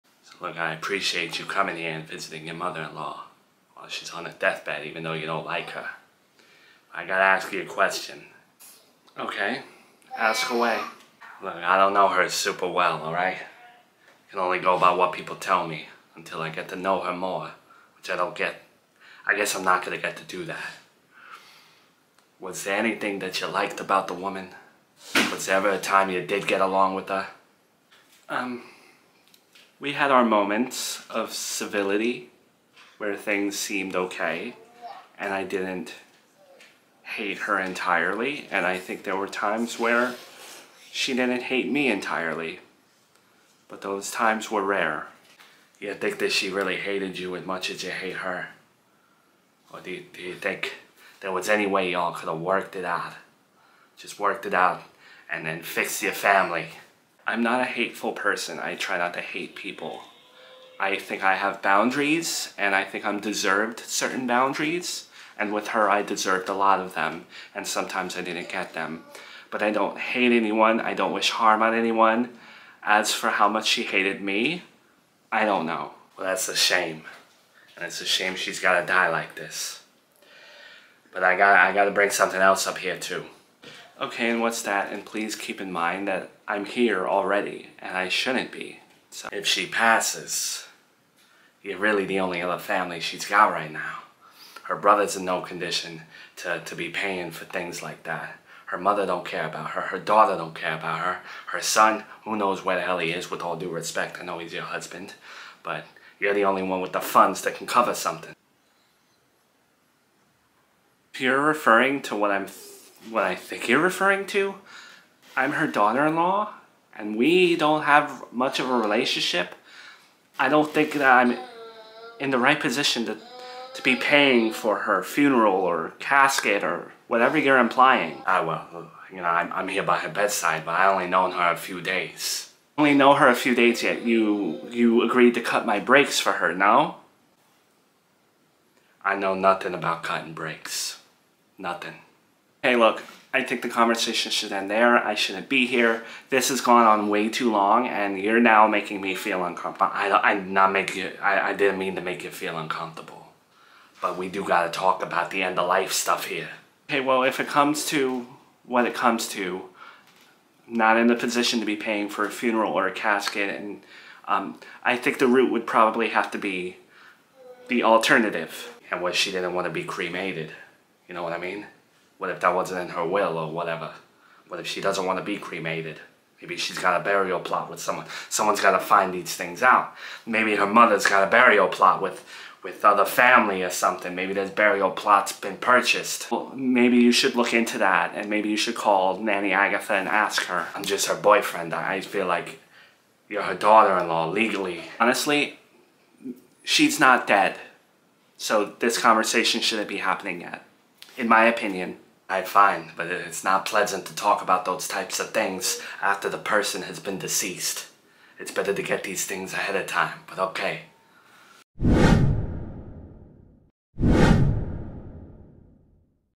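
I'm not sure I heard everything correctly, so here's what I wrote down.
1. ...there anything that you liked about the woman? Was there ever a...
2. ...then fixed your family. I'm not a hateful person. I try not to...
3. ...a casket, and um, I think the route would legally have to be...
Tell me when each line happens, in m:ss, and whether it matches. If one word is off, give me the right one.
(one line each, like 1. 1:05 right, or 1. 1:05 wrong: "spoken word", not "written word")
1. 0:22 right
2. 0:55 right
3. 2:42 wrong: "probably", not "legally".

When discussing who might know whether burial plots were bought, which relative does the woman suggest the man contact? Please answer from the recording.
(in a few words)
Nanny Agatha.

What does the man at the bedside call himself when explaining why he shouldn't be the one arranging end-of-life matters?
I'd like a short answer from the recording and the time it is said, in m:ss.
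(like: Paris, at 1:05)
her boyfriend, at 3:11.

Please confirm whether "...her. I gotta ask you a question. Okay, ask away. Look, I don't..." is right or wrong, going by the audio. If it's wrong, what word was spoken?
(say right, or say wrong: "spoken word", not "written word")
right.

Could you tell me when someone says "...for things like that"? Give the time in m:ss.
1:37.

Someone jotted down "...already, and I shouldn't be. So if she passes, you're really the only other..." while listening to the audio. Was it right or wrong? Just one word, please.
right.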